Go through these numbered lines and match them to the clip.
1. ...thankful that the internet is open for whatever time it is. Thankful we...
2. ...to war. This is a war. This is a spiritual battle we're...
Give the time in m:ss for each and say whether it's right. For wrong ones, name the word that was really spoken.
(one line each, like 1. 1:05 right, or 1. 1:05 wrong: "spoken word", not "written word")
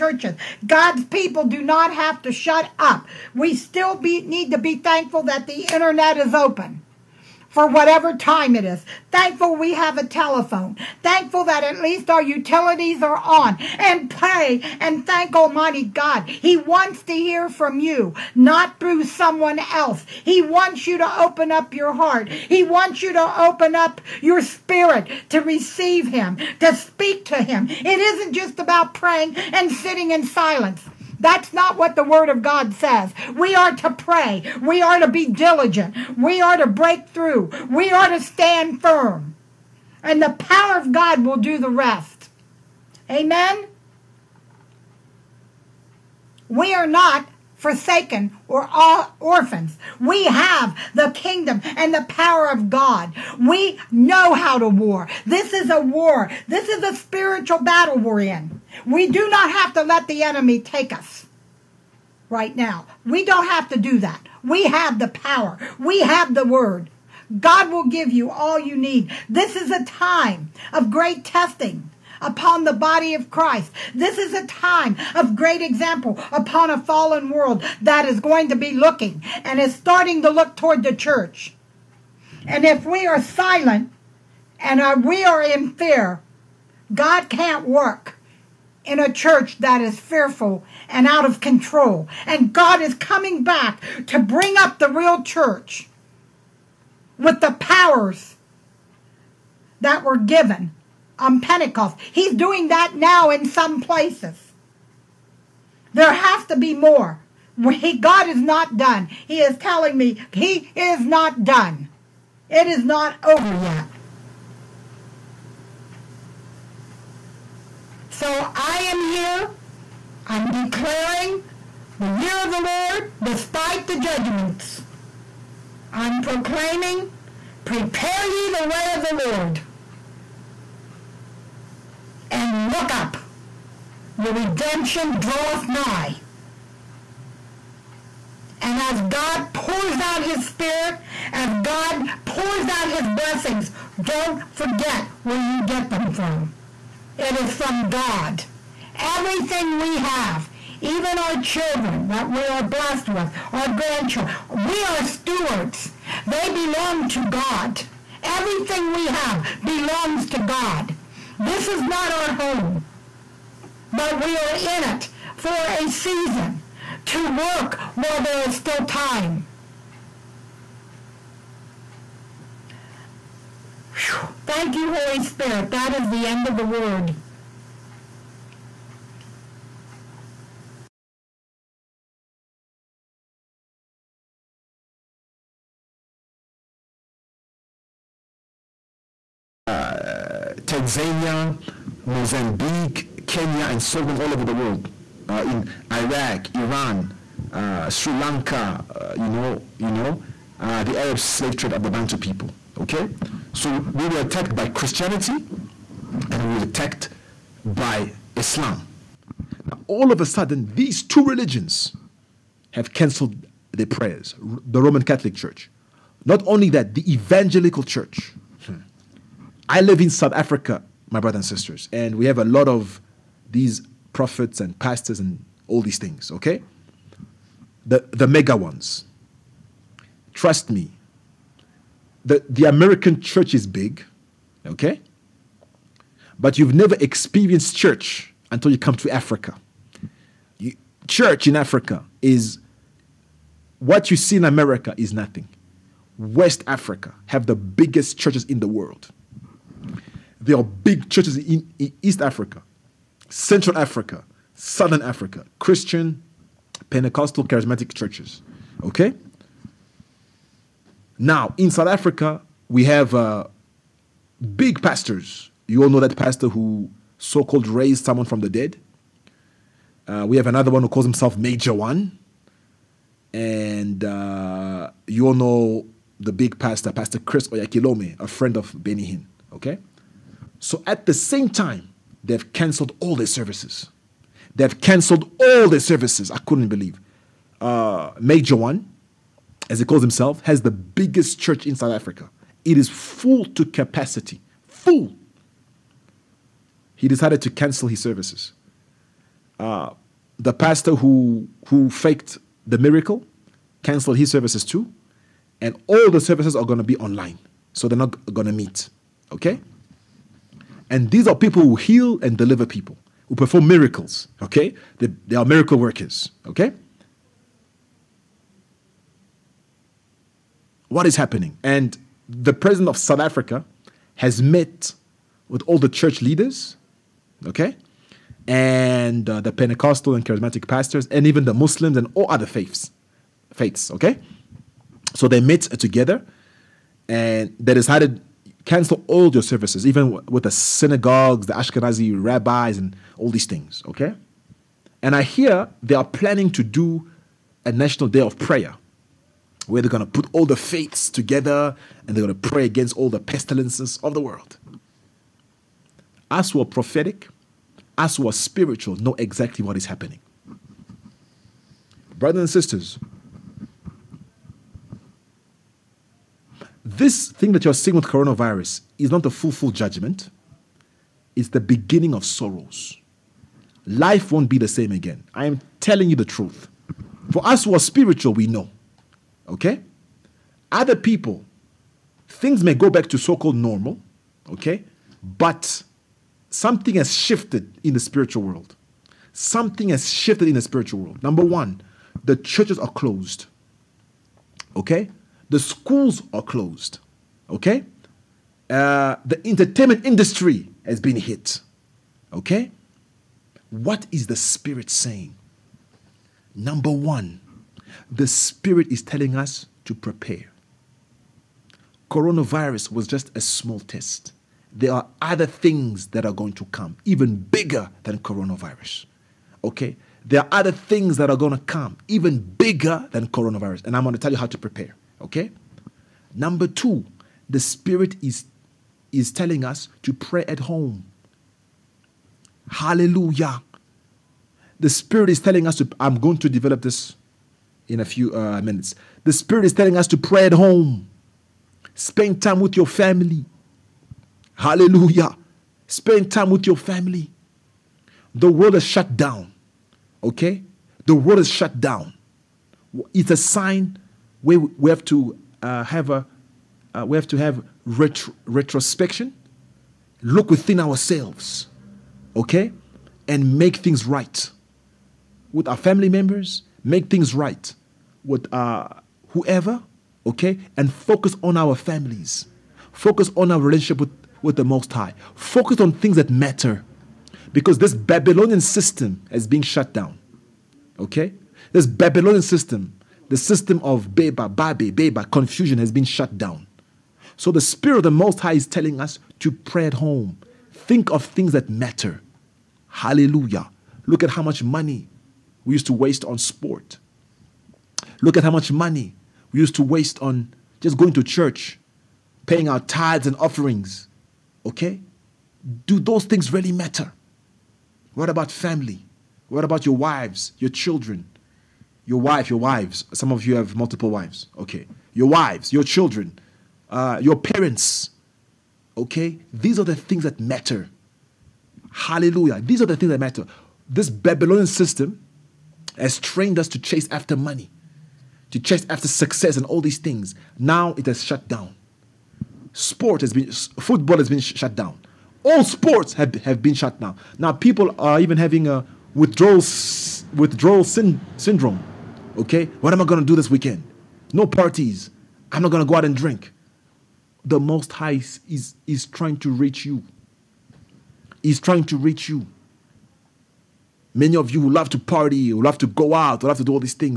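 1. 0:04 right
2. 0:54 right.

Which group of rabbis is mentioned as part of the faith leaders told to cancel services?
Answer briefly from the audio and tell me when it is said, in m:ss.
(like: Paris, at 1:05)
Ashkenazi, at 5:41.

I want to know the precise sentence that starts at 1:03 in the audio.
We don't have to do that.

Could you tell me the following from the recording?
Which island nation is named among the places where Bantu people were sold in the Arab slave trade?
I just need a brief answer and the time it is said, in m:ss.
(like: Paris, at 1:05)
Sri Lanka, at 3:17.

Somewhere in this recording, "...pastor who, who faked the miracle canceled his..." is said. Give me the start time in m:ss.
5:00.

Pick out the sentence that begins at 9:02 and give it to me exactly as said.
Okay, what am I going to do this weekend?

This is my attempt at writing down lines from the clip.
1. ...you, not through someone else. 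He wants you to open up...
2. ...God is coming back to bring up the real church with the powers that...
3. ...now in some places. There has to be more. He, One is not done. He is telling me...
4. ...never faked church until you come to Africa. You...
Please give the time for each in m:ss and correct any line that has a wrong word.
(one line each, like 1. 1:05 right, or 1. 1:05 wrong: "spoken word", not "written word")
1. 0:17 right
2. 1:32 right
3. 1:42 wrong: "God", not "One"
4. 3:56 wrong: "experienced", not "faked".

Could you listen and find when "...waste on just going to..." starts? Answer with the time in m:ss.
8:19.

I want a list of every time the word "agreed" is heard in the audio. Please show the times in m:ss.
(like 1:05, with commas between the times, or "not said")
not said.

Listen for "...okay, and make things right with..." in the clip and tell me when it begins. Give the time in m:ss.
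7:42.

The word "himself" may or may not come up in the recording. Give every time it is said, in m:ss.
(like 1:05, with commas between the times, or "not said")
4:31, 4:50.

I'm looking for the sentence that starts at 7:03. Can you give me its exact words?
And I'm going to tell you how to prepare.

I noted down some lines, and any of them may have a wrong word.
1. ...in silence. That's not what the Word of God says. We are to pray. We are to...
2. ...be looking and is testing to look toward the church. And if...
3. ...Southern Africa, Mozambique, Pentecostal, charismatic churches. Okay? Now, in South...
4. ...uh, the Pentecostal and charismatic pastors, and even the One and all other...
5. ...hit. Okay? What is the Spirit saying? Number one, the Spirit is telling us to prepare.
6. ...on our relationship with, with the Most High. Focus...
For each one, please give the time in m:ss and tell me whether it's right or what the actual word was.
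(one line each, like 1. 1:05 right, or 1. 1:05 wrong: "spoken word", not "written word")
1. 0:30 right
2. 1:18 wrong: "starting", not "testing"
3. 4:14 wrong: "Christian", not "Mozambique"
4. 5:29 wrong: "Muslims", not "One"
5. 6:41 right
6. 7:53 right.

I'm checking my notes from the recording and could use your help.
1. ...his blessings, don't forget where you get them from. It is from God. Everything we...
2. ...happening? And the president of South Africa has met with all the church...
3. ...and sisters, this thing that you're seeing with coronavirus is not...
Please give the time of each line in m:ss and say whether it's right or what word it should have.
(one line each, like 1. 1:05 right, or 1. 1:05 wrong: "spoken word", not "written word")
1. 2:22 right
2. 5:21 right
3. 6:02 right.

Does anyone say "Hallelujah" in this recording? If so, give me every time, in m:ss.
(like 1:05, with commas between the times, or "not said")
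7:12, 7:24, 8:12, 8:41.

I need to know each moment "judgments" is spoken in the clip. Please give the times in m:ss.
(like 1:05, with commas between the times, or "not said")
2:03, 6:09.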